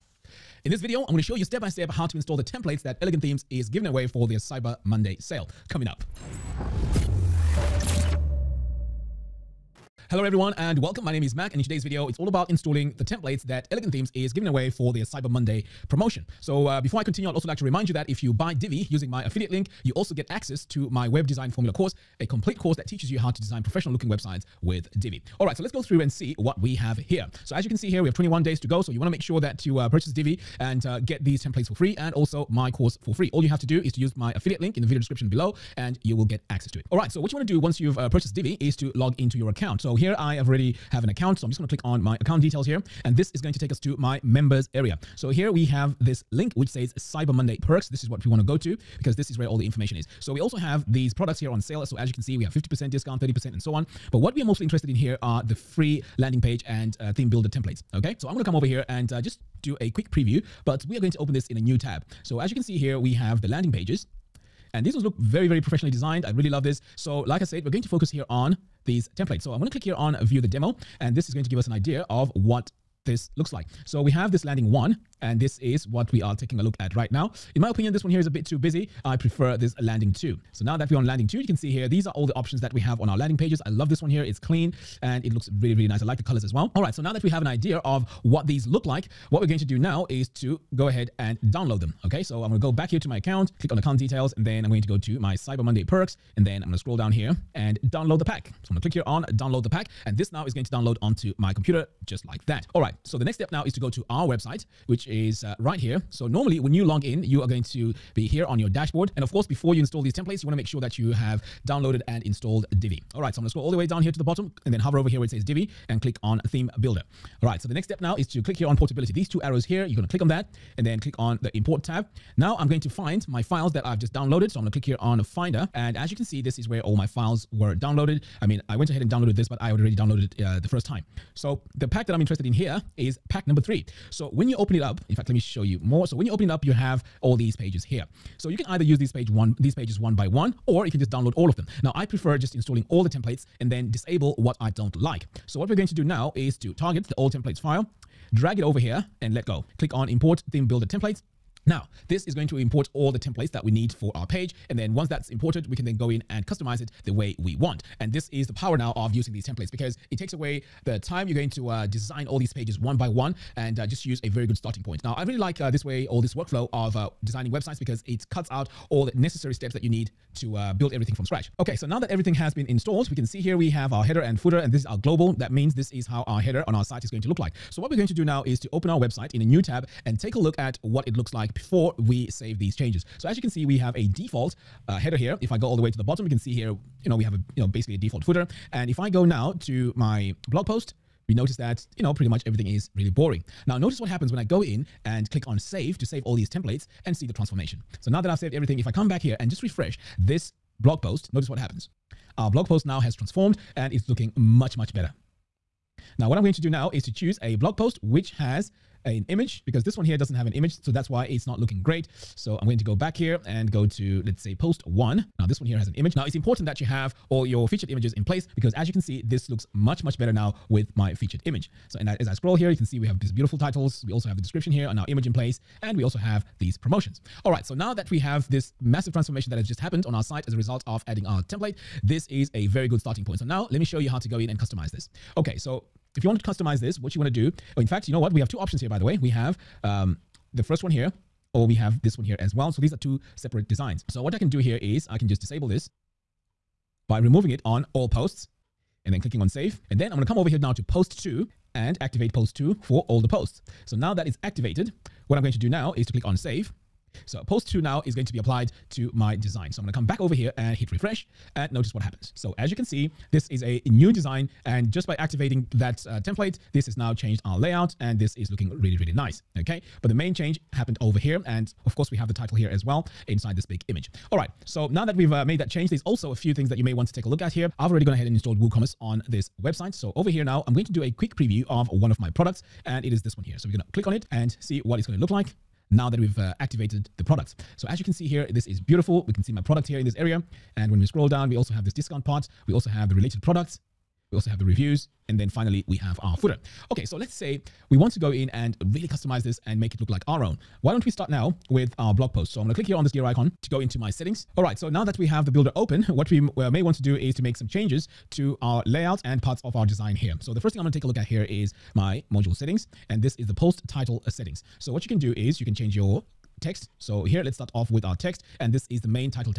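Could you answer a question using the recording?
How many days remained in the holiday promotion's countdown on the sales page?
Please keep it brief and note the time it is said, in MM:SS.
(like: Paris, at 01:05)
21, at 00:28.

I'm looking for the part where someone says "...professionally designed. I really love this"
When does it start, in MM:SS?
01:05.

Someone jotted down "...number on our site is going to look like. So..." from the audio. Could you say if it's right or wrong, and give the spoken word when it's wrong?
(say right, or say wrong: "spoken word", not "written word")
wrong: "header", not "number".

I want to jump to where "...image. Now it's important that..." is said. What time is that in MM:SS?
03:35.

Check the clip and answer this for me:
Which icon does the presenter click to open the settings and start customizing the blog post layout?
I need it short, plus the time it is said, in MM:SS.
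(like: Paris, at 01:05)
Gear icon, at 05:03.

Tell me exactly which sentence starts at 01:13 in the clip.
So we have this landing one, and this is what we are taking a look at right now.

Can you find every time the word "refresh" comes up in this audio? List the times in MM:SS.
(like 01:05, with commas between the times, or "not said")
03:19, 04:20.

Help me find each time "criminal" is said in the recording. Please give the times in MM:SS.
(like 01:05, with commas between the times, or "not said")
not said.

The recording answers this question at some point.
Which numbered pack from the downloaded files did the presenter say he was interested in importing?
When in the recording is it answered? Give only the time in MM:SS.
02:13.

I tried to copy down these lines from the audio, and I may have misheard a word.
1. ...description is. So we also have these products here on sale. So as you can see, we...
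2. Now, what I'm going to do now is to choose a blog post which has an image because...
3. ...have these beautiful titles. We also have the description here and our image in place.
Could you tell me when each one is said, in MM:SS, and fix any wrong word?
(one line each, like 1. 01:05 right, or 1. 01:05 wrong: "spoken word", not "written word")
1. 00:49 wrong: "information", not "description"
2. 03:26 right
3. 03:43 right.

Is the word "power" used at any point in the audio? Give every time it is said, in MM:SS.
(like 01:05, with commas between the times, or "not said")
02:38.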